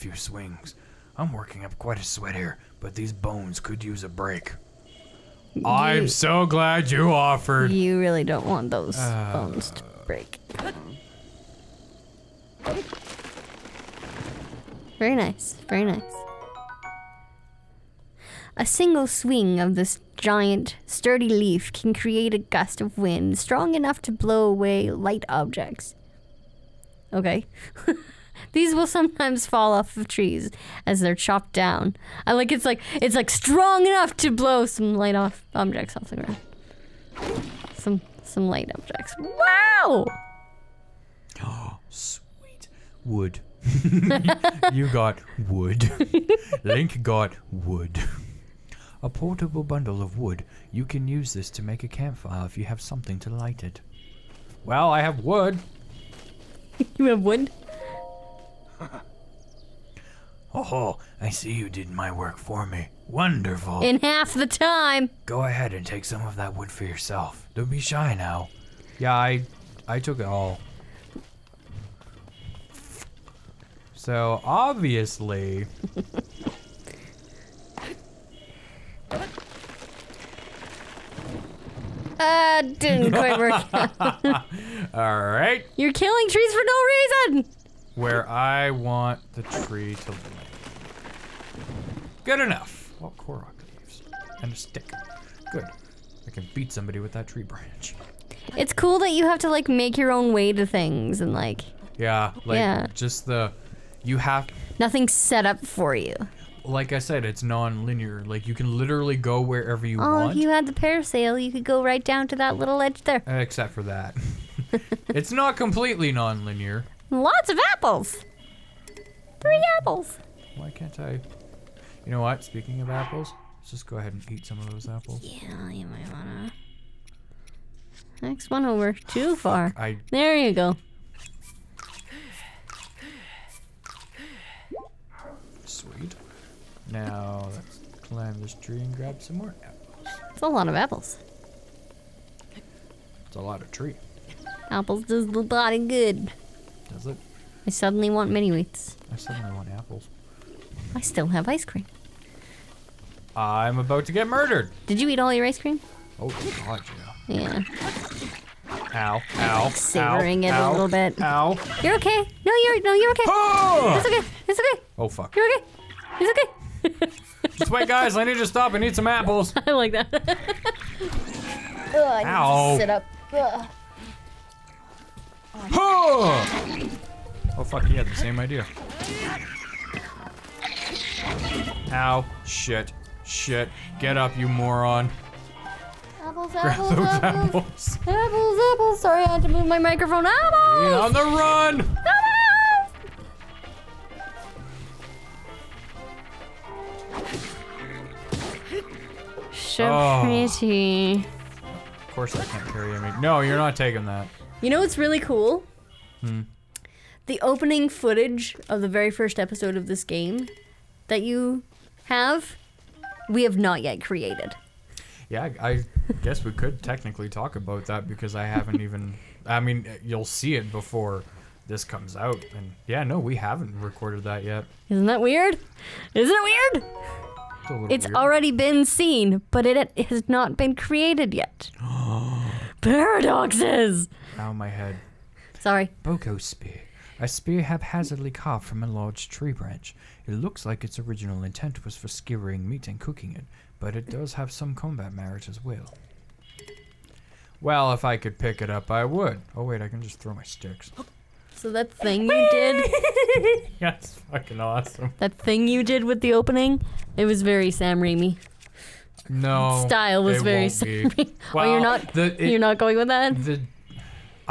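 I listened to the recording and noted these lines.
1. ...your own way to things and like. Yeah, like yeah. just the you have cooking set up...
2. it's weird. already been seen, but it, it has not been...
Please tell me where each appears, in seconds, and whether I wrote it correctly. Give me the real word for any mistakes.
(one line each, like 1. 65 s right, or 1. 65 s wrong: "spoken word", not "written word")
1. 99 s wrong: "nothing", not "cooking"
2. 227 s right.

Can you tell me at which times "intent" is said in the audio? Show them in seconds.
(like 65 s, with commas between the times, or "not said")
241 s.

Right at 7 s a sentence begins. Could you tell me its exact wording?
You really don't want those uh, bones to break.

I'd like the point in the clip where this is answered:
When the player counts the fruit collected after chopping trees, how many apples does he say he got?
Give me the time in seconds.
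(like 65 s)
119 s.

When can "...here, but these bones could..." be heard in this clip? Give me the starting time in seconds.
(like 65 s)
2 s.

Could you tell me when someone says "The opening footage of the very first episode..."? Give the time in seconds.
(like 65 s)
207 s.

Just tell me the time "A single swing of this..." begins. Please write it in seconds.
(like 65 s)
18 s.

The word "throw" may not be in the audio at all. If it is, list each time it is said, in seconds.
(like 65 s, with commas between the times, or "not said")
250 s.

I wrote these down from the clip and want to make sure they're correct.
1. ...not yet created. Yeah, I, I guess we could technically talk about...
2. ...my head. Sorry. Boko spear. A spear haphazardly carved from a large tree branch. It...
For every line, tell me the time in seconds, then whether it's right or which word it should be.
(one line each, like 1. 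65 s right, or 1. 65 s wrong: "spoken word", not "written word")
1. 213 s right
2. 234 s right.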